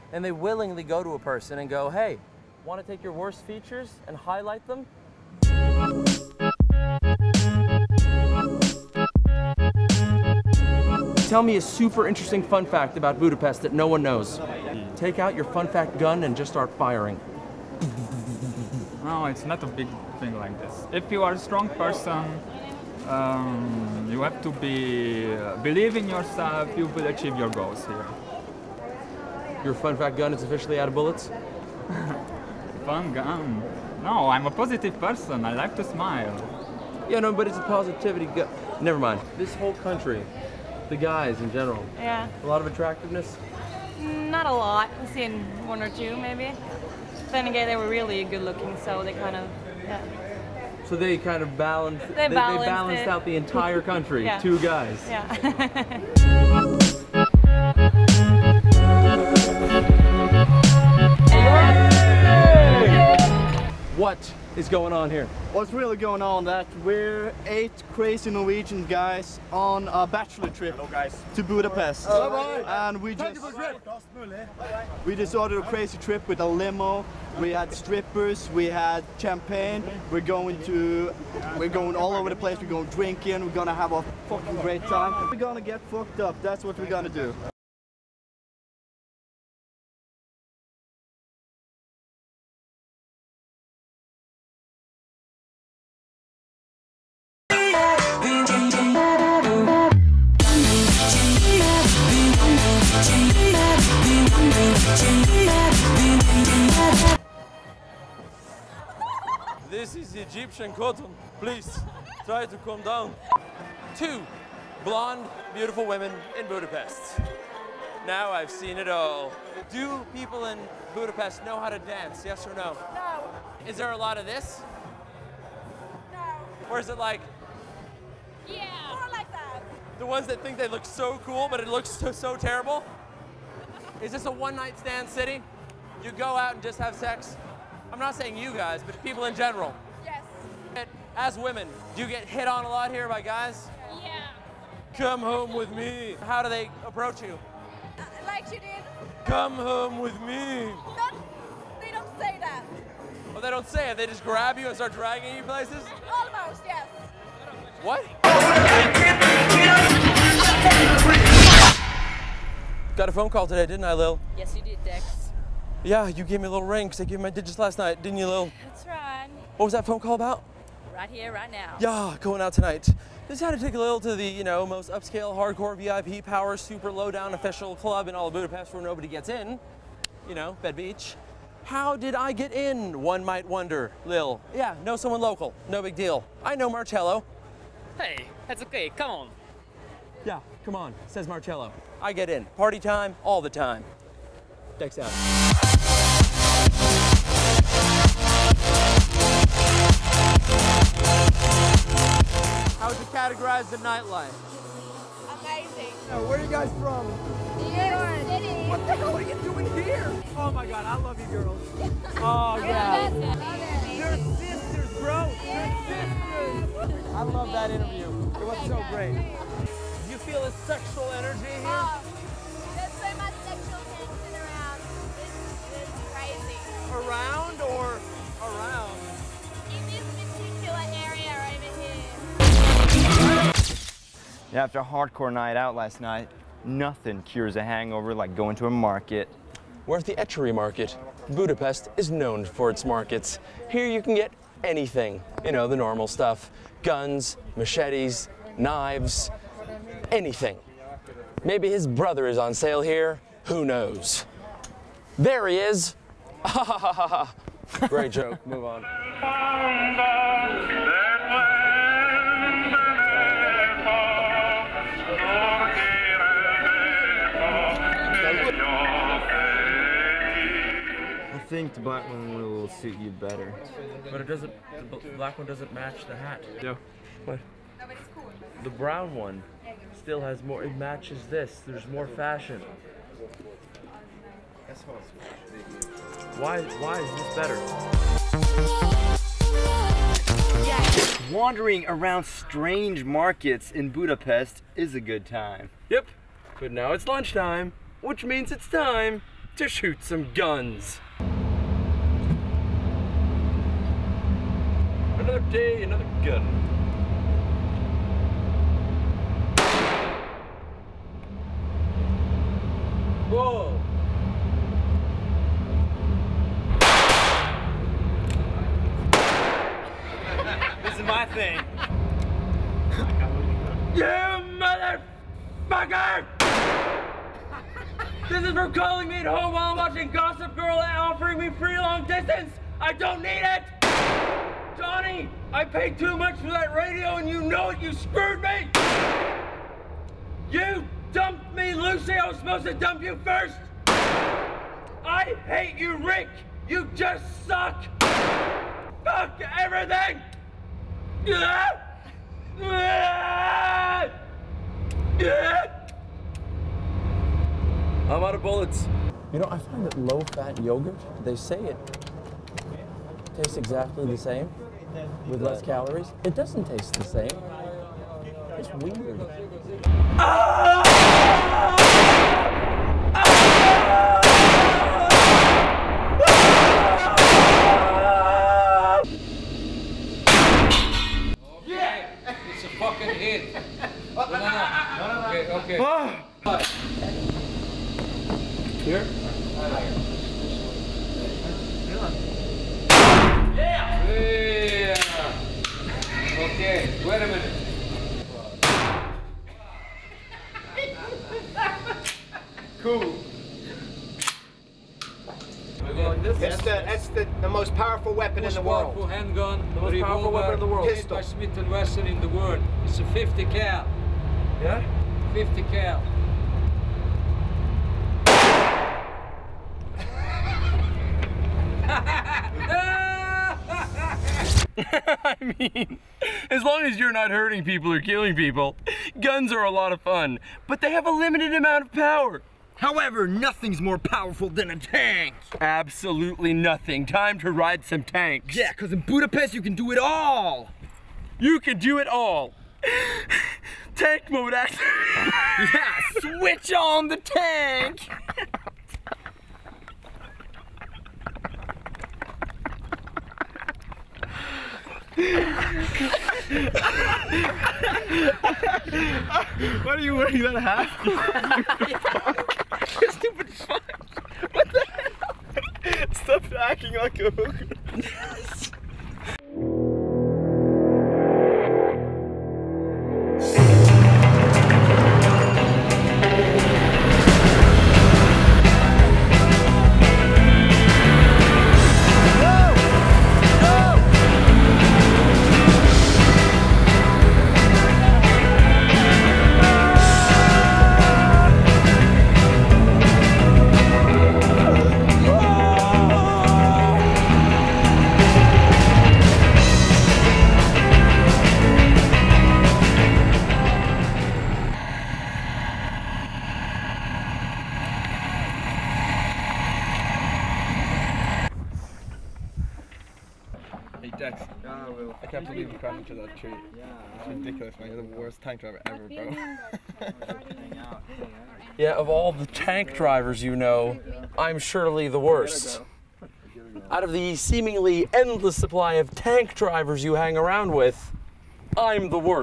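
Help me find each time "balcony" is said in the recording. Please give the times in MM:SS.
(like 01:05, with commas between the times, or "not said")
not said.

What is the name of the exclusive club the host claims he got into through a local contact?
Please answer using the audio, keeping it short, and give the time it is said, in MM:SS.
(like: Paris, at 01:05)
Bed Beach, at 03:00.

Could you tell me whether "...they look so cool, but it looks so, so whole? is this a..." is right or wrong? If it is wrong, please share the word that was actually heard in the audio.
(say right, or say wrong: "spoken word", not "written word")
wrong: "terrible", not "whole".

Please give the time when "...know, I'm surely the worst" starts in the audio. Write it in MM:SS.
08:43.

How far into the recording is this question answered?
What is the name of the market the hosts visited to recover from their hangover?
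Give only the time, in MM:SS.
04:00.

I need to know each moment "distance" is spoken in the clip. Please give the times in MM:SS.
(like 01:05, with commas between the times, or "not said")
05:32.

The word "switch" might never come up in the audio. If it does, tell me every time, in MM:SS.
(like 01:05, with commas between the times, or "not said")
07:26.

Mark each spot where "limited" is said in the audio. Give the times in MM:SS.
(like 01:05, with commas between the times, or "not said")
07:11.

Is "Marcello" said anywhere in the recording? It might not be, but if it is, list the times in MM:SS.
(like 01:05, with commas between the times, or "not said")
03:06, 03:11.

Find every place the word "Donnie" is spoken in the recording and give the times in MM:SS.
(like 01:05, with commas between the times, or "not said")
05:34.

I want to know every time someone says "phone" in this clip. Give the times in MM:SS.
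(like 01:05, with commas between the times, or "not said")
02:43, 02:49.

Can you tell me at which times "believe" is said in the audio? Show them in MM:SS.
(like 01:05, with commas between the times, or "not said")
00:25, 08:35.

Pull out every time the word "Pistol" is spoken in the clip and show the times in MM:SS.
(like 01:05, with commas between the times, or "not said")
06:50.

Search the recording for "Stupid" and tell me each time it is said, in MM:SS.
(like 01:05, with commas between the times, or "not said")
07:43.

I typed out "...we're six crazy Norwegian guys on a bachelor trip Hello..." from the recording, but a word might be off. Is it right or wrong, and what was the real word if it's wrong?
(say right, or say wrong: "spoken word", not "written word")
wrong: "eight", not "six".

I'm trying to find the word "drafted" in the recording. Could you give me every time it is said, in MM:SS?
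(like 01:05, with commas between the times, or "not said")
not said.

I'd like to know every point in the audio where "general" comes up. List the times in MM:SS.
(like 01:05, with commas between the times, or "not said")
00:41, 02:19.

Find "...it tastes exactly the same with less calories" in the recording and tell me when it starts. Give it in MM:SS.
06:01.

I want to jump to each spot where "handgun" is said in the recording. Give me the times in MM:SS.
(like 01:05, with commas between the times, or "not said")
06:49.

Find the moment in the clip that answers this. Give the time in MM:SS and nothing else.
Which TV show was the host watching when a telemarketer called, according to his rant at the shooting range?
05:30.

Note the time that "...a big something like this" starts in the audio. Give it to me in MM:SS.
00:19.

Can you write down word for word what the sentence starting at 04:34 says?
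But it doesn't, the black one doesn't match the hat.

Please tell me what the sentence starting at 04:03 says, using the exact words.
Here you can get anything, you know, the normal stuff.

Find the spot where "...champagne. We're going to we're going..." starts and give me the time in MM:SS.
01:19.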